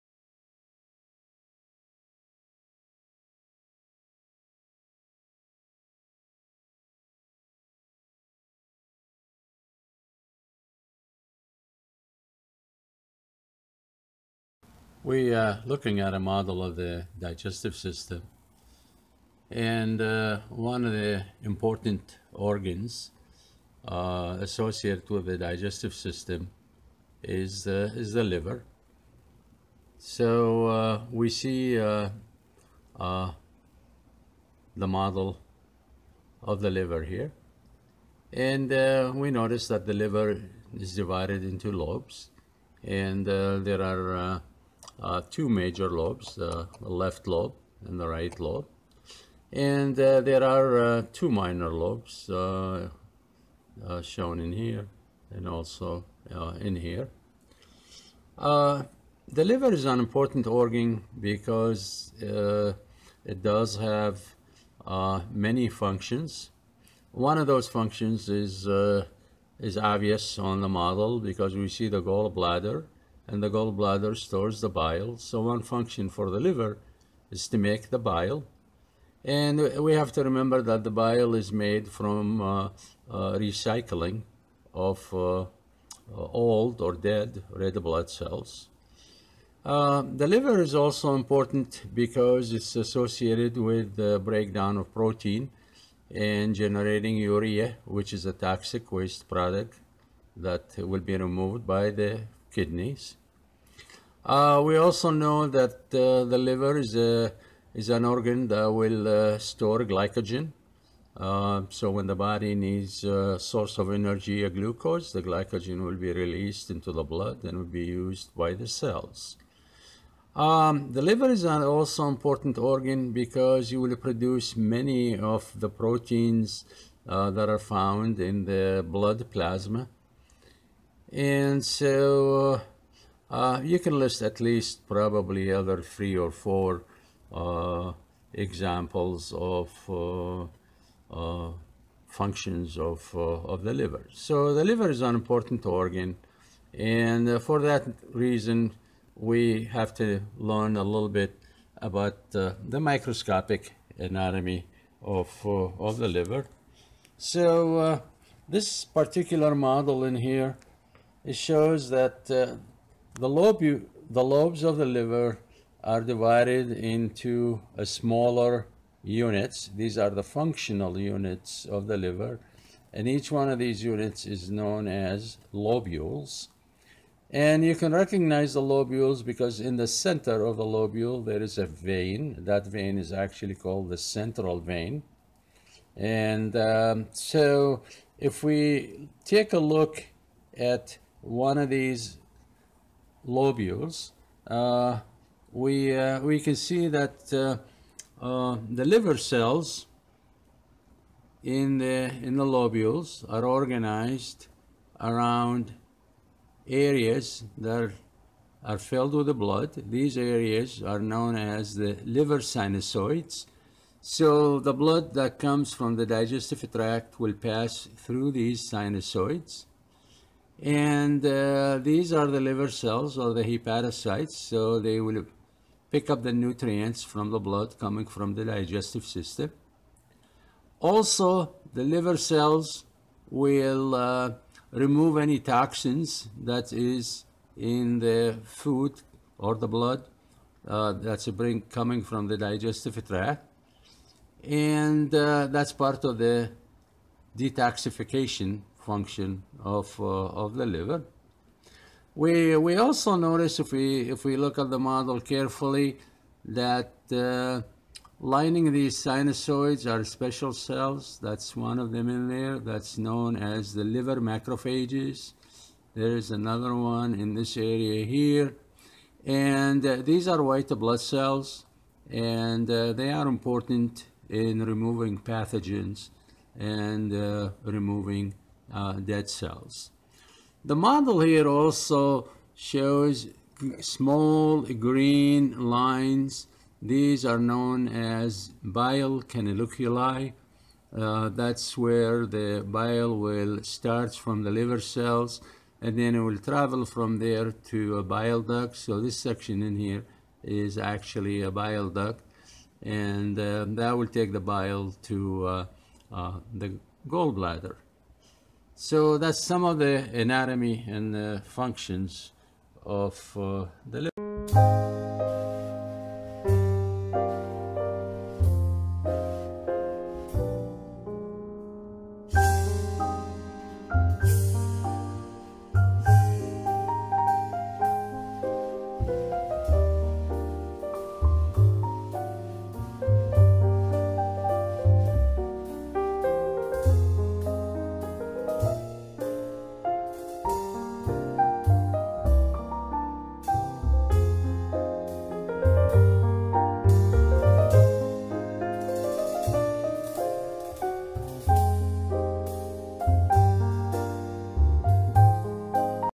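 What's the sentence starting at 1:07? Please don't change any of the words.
One of those functions is is obvious on the model because we see the gallbladder and the gallbladder stores the bile.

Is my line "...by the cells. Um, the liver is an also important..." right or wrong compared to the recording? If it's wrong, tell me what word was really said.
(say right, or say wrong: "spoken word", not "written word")
right.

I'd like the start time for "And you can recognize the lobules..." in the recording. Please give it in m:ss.
2:57.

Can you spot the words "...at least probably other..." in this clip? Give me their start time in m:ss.
2:14.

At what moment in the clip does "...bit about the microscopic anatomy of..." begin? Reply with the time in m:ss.
2:31.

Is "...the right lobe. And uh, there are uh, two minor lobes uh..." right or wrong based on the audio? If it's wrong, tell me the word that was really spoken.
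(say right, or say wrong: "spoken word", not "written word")
right.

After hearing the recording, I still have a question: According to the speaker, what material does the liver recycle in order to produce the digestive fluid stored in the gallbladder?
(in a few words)
old or dead red blood cells.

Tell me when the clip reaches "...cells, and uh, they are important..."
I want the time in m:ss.
4:30.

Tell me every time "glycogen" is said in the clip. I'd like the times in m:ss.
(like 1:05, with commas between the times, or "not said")
1:49, 1:55.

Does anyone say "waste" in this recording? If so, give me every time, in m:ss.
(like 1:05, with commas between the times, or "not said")
1:38.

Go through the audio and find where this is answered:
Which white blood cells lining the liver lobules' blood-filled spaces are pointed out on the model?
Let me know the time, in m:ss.
4:23.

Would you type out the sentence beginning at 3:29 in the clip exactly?
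These areas are known as the liver sinusoids.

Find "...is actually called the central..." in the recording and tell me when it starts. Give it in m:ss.
3:02.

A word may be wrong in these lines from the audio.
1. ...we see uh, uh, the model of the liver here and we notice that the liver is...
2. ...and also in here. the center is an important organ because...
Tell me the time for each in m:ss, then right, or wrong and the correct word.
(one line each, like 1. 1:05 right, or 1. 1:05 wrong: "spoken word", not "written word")
1. 0:31 right
2. 0:55 wrong: "liver", not "center".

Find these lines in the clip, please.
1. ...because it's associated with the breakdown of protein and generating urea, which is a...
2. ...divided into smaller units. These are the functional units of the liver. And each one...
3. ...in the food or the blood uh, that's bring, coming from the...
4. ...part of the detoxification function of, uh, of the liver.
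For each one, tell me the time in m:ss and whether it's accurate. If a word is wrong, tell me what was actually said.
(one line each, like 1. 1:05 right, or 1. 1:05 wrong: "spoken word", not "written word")
1. 1:31 right
2. 2:46 right
3. 3:57 right
4. 4:05 right.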